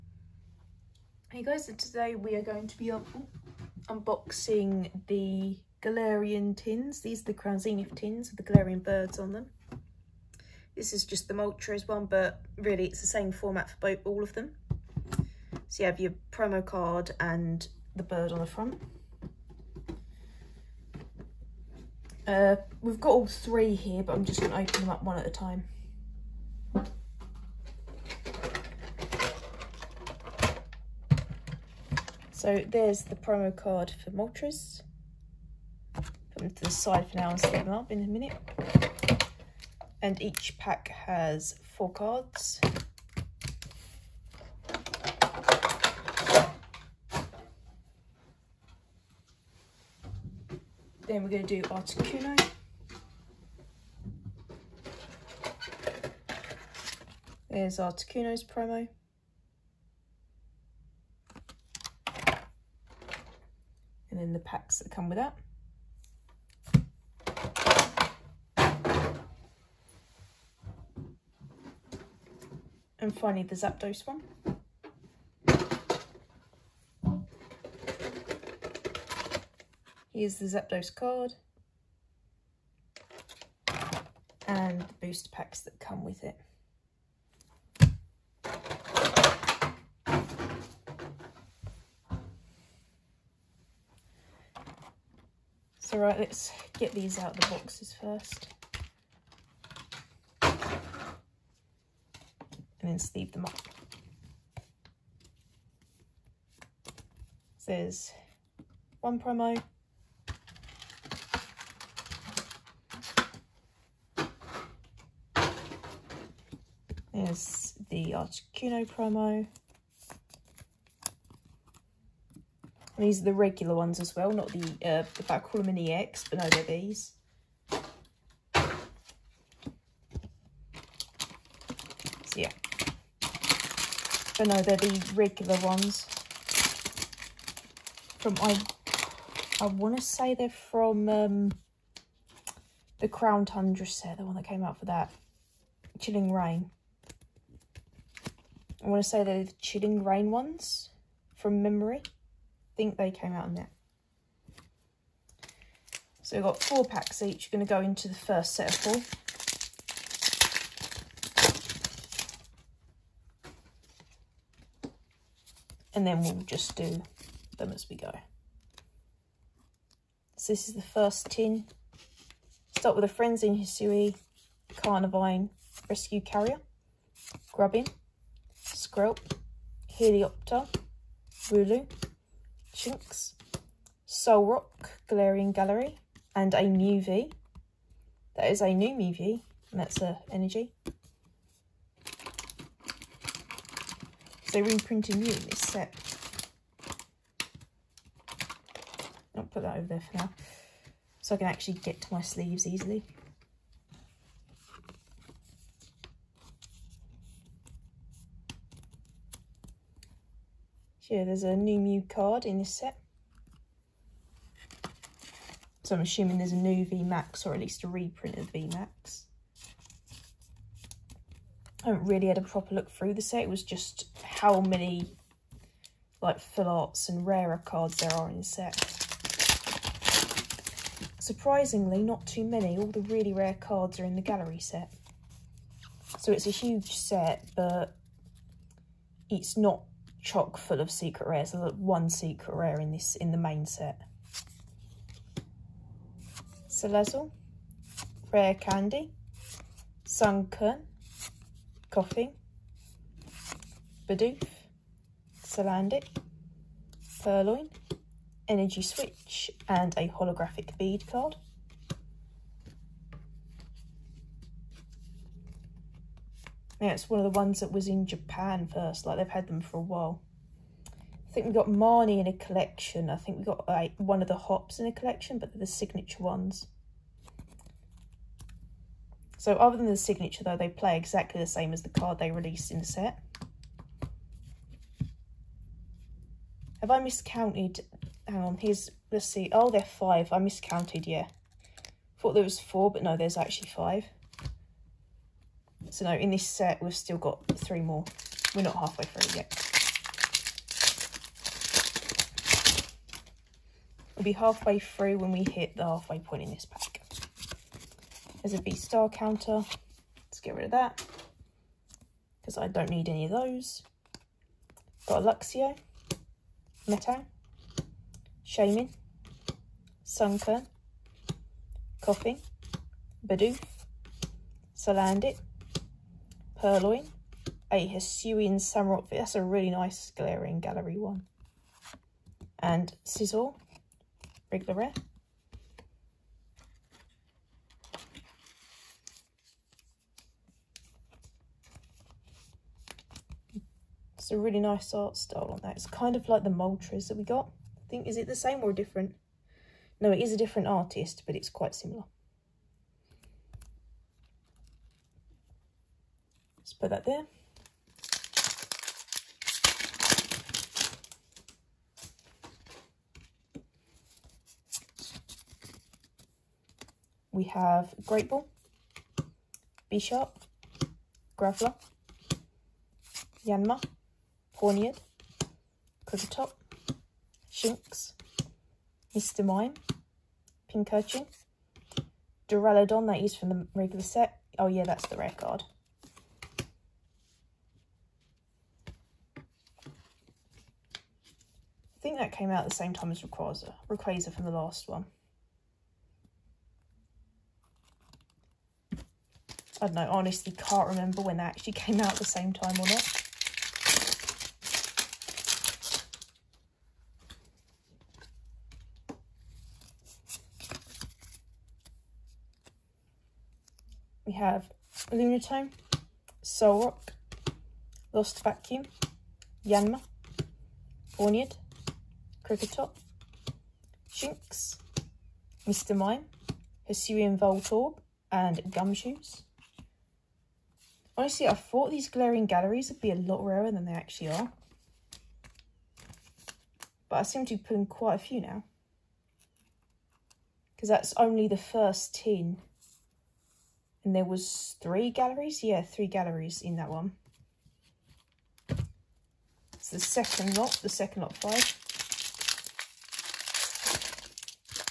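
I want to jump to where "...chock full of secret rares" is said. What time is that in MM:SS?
04:00.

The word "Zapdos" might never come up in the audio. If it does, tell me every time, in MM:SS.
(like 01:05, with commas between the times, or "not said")
01:13, 01:20.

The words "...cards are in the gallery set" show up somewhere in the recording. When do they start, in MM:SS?
03:53.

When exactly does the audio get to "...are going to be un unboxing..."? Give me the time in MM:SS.
00:02.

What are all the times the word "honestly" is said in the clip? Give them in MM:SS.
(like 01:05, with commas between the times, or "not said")
06:40, 07:11.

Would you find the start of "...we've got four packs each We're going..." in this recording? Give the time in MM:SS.
02:36.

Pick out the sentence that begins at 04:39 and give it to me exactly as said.
So other than the signature though, they play exactly the same as the card they released in the set.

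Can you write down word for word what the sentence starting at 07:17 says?
But I seem to be pulling quite a few now.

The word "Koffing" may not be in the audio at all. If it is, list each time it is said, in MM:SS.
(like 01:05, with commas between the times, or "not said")
04:11, 05:22.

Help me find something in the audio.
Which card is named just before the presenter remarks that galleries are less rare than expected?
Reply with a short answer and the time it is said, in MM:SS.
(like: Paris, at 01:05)
Gumshoos, at 07:08.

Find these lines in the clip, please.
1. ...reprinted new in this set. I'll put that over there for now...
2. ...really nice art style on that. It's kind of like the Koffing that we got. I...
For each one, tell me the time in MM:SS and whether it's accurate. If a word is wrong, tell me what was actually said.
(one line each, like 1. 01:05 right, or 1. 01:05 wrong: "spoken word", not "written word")
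1. 03:14 right
2. 05:44 wrong: "Moltres", not "Koffing".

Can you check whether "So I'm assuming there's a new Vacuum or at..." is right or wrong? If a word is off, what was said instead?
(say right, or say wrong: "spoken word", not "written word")
wrong: "VMAX", not "Vacuum".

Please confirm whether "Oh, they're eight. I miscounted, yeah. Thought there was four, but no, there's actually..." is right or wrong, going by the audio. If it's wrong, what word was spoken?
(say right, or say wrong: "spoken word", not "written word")
wrong: "five", not "eight".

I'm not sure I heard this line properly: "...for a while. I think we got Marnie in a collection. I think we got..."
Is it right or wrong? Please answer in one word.
right.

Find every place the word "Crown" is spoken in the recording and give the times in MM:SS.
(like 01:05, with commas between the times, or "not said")
00:07, 02:23.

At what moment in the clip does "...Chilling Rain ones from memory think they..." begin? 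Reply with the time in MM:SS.
02:29.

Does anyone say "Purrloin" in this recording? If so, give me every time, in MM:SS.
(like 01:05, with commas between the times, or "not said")
04:17, 05:26.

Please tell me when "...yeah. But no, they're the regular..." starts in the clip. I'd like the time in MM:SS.
02:12.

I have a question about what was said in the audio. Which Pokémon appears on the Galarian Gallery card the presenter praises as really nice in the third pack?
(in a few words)
Hisuian Samurott.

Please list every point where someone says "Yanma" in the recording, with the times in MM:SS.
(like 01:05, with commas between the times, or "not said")
06:13, 06:59.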